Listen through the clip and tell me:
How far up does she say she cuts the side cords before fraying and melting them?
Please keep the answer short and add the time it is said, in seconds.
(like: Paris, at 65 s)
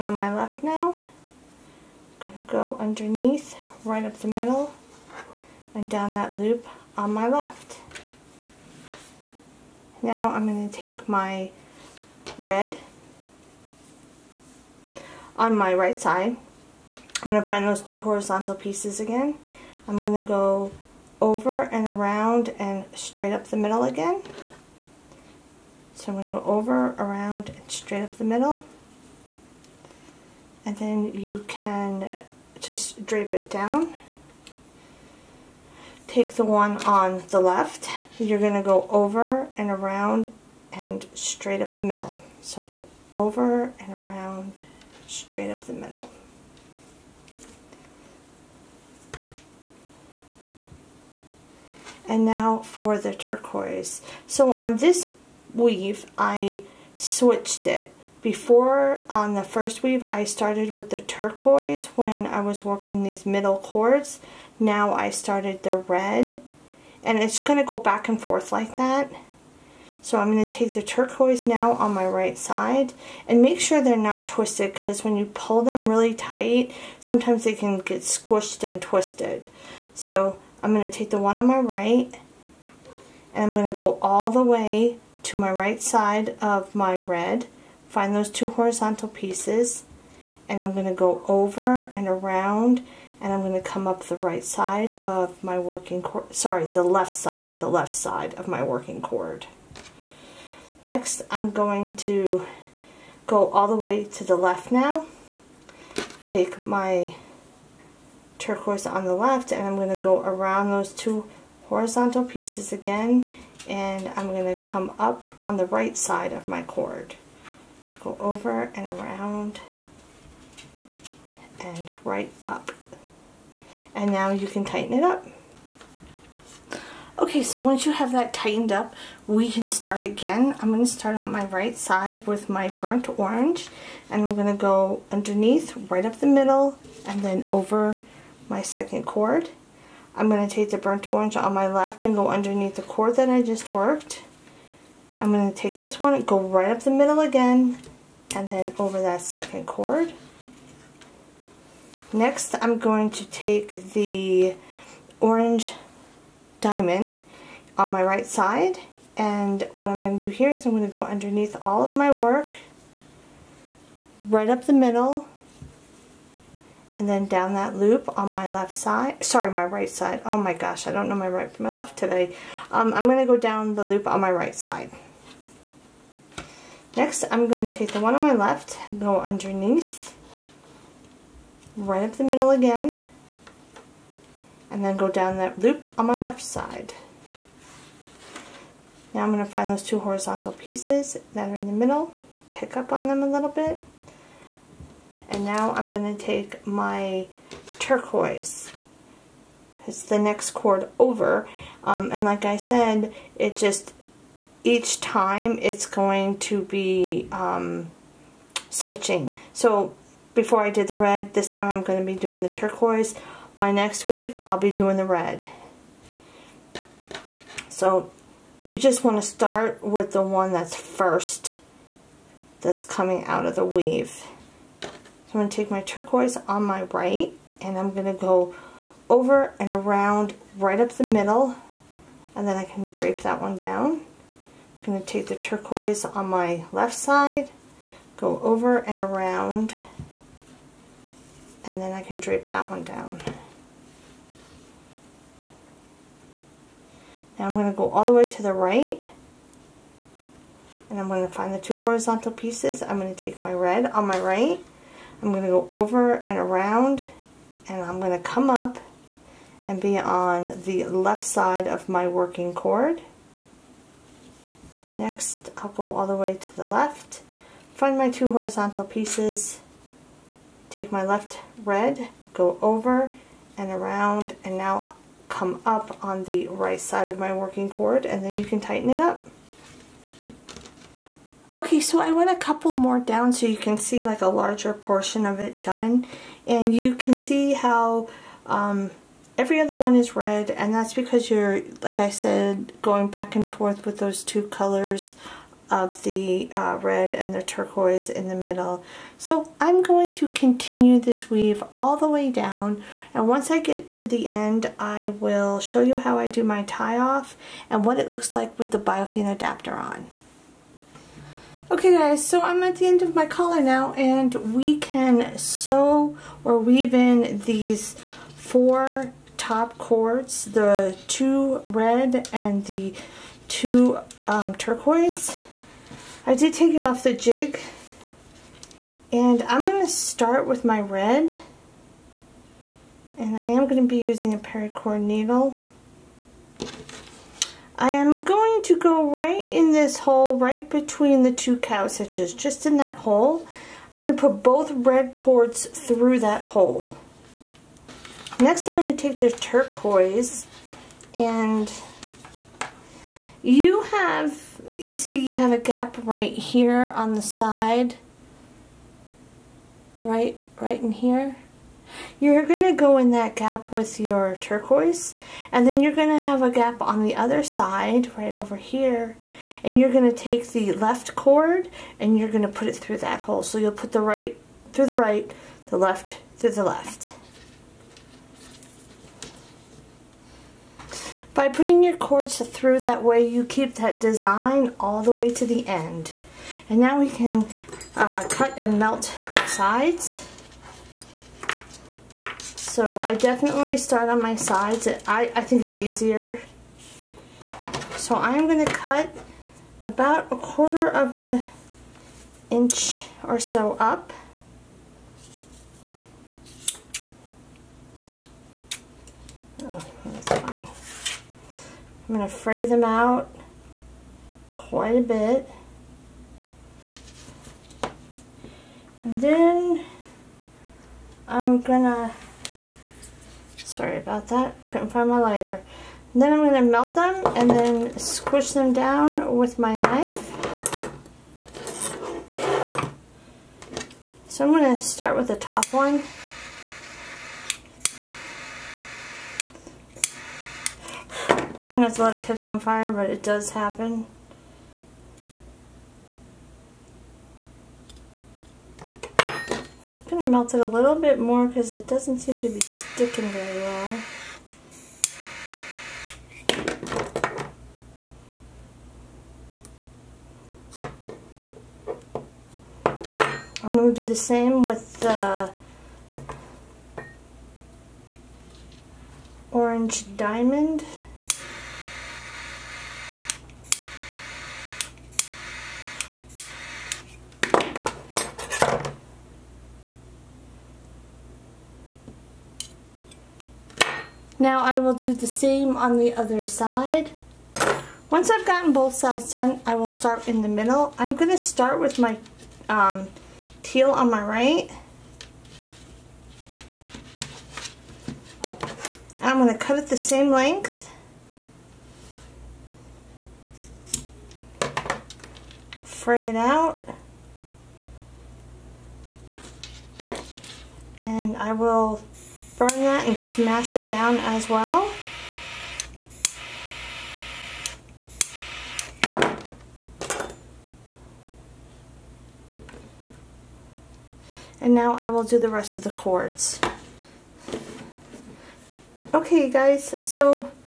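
a quarter of an inch, at 400 s.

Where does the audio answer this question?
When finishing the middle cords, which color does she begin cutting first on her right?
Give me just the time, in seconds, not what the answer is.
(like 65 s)
493 s.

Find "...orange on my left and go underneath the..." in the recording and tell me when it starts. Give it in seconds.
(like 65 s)
141 s.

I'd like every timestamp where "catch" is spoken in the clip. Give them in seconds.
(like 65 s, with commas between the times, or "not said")
442 s.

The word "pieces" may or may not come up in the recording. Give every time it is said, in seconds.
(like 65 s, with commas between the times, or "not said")
18 s, 89 s, 112 s, 190 s, 252 s, 268 s.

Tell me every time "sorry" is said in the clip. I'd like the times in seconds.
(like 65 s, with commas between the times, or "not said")
96 s, 169 s, 423 s.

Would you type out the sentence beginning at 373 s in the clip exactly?
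So you'll put the right through the right, the left through the left.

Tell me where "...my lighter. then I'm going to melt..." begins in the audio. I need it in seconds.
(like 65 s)
425 s.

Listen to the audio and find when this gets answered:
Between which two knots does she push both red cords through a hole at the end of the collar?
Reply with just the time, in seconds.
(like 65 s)
341 s.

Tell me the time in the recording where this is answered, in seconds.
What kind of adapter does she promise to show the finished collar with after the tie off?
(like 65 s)
308 s.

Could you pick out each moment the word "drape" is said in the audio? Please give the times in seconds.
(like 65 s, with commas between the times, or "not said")
33 s, 232 s, 242 s.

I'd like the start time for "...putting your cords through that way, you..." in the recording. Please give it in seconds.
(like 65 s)
381 s.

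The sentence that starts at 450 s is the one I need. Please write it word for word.
melt it a little bit more because it doesn't seem to be sticking very well.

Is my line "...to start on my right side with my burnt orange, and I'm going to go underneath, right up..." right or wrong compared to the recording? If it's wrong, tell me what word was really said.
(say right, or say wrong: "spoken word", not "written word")
right.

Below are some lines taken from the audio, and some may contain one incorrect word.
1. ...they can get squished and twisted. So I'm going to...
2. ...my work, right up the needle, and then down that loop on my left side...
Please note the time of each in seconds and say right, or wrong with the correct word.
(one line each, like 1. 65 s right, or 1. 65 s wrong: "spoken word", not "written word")
1. 77 s right
2. 161 s wrong: "middle", not "needle".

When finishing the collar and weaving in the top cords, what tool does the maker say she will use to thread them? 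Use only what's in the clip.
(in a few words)
paracord needle.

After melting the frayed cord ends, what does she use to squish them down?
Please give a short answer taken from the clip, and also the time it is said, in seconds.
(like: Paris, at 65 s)
knife, at 429 s.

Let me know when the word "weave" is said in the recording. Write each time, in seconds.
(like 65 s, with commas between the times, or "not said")
55 s, 59 s, 214 s, 223 s, 301 s, 316 s.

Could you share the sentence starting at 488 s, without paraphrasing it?
Once I've gotten both sides done, I will start in the middle.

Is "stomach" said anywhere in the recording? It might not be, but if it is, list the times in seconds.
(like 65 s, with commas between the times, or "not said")
not said.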